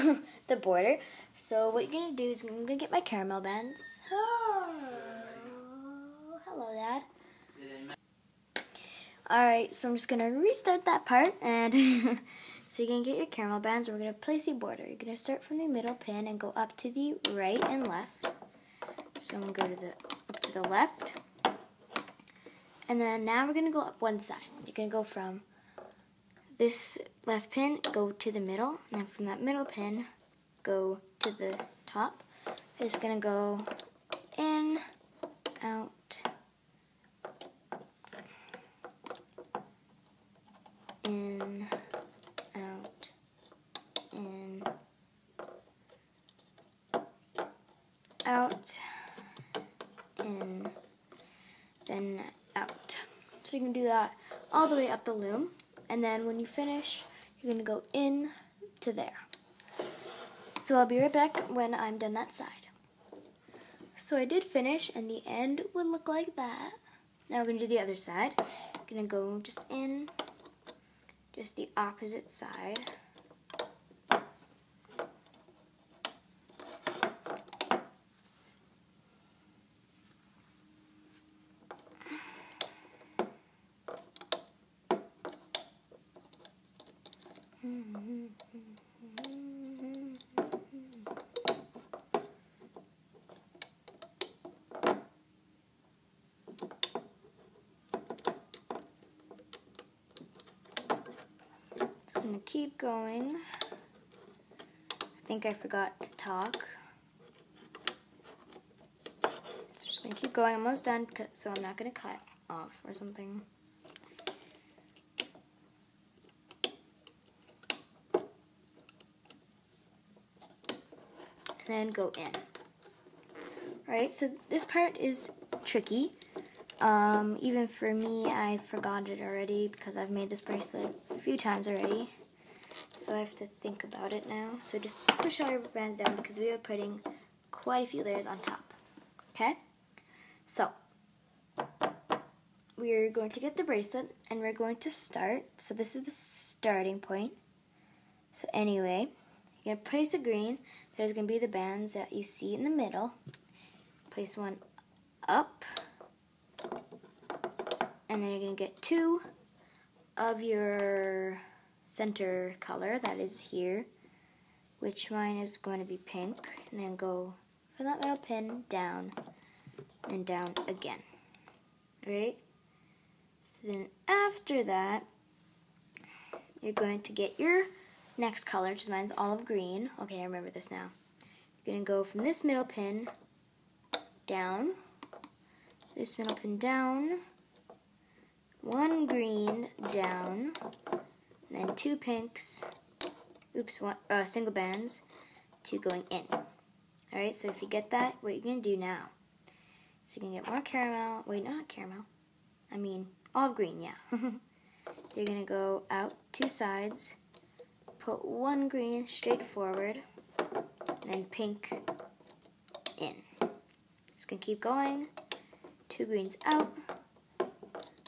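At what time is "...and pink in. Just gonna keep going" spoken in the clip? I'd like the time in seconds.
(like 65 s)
211 s.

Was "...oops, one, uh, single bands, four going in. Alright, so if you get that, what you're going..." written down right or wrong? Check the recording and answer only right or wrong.
wrong.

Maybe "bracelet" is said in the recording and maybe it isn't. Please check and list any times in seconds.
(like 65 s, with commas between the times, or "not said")
130 s, 143 s.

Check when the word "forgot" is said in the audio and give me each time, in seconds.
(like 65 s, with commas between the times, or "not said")
105 s, 128 s.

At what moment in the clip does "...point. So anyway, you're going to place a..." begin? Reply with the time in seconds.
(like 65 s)
146 s.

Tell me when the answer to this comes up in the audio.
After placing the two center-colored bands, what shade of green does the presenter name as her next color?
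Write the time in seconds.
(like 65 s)
179 s.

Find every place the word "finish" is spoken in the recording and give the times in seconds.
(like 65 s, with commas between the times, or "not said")
56 s, 64 s.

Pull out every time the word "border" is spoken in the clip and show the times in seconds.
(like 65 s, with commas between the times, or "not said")
0 s, 14 s.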